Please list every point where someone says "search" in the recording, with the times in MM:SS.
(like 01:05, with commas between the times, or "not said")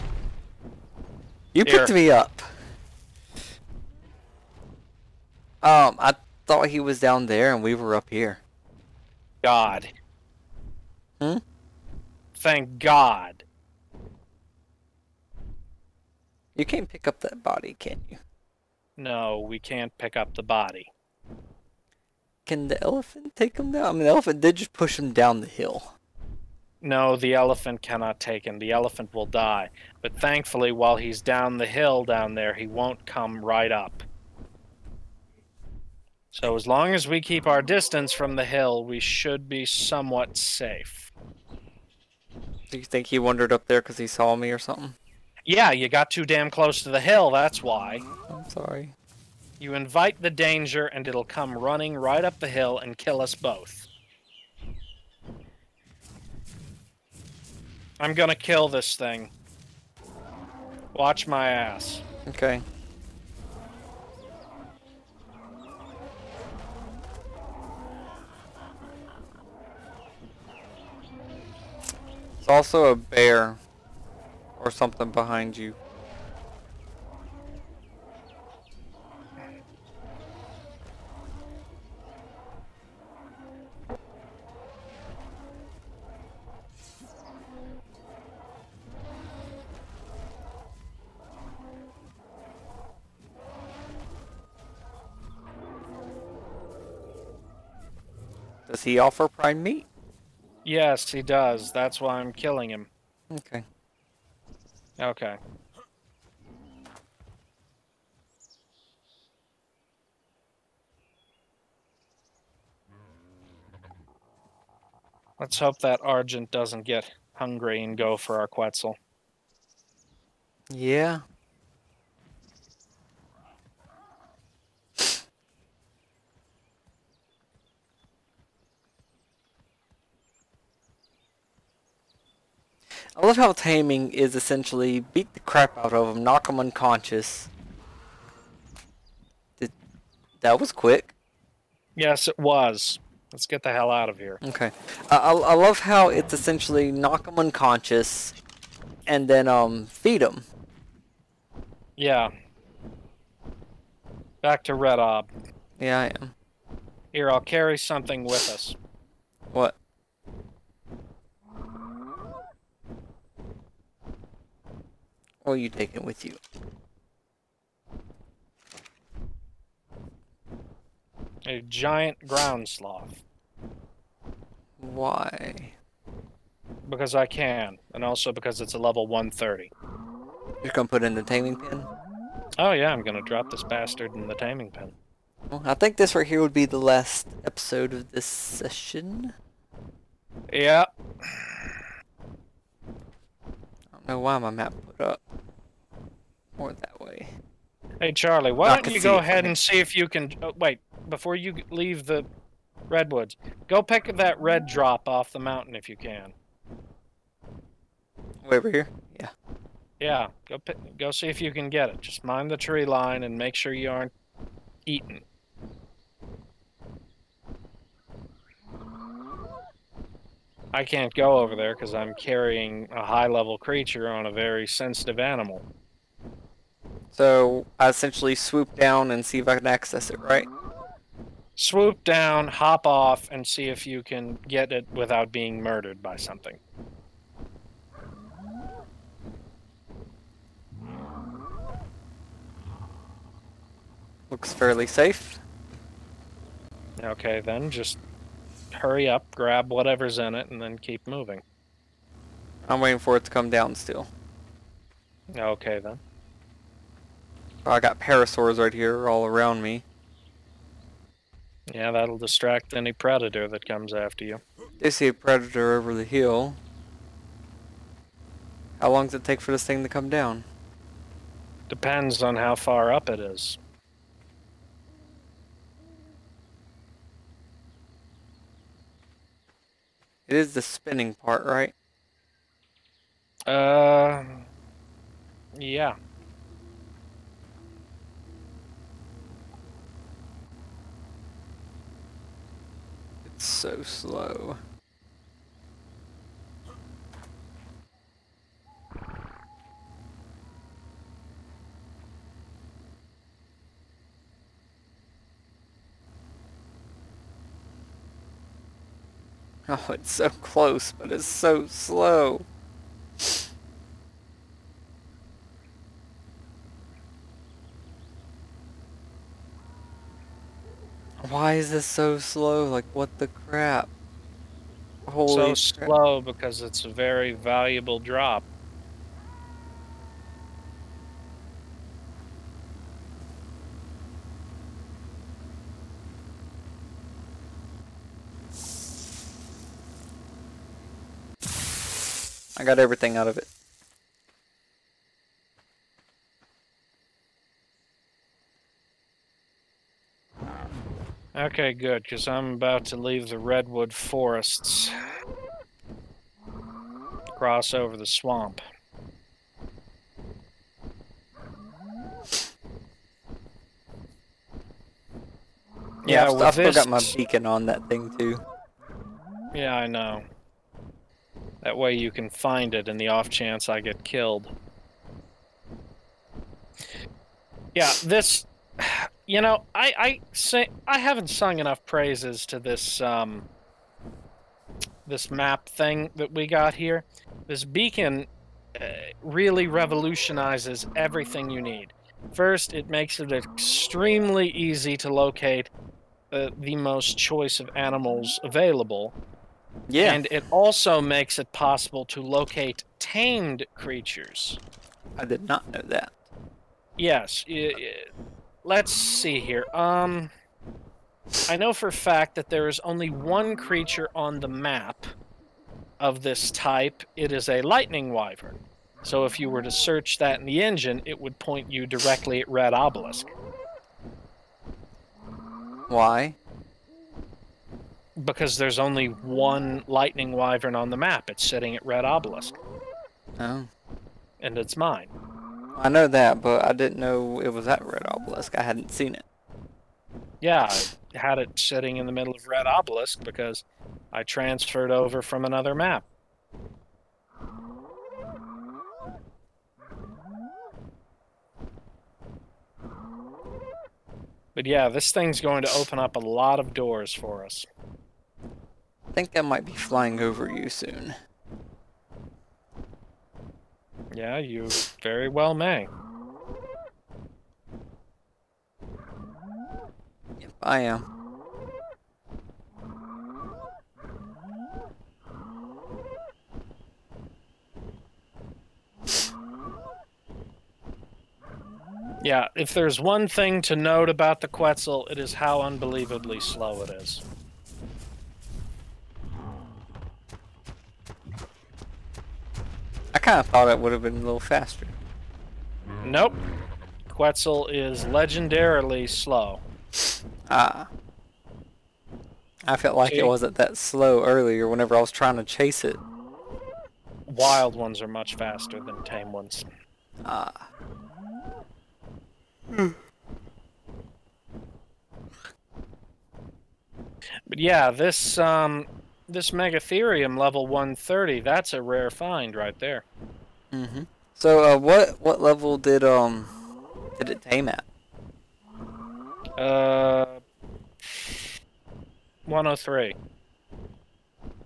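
06:59.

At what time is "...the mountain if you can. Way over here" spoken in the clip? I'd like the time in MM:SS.
03:25.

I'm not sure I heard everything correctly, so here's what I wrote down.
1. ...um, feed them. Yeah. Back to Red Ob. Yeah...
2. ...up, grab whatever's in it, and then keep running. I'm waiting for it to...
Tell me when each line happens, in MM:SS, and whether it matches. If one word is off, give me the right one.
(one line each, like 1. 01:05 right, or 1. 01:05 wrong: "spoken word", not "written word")
1. 02:29 right
2. 04:09 wrong: "moving", not "running".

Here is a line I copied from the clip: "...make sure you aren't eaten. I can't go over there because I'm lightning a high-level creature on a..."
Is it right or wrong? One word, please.
wrong.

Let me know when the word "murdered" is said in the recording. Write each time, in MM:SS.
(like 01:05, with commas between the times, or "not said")
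03:55.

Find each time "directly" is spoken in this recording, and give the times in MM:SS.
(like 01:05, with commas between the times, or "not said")
07:01.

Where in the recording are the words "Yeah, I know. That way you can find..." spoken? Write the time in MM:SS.
06:09.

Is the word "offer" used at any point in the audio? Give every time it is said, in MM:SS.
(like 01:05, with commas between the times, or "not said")
01:38.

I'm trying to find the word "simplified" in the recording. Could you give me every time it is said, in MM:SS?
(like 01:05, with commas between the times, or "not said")
not said.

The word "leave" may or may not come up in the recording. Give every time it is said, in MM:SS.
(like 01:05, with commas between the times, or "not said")
03:21, 05:52.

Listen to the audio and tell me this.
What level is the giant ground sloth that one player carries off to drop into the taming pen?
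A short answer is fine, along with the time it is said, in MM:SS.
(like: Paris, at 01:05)
130, at 02:58.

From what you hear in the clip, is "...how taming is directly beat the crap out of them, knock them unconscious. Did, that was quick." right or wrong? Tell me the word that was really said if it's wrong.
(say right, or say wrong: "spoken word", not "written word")
wrong: "essentially", not "directly".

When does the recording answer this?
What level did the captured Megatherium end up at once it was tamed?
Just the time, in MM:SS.
08:52.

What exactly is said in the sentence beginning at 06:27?
This beacon uh, really revolutionizes everything you need.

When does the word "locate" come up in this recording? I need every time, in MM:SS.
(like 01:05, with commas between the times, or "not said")
06:35, 06:42.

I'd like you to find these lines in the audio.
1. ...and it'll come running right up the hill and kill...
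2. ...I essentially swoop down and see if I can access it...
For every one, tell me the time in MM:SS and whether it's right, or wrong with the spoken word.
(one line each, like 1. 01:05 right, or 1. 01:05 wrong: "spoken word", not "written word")
1. 00:50 right
2. 03:47 right.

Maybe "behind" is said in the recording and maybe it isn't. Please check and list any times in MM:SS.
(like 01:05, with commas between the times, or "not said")
01:15.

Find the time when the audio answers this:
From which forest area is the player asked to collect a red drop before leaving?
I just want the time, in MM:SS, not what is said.
03:22.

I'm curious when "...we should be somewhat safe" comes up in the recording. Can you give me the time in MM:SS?
00:38.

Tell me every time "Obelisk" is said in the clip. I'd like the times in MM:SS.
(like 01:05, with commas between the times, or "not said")
07:02, 07:12, 07:18, 07:22.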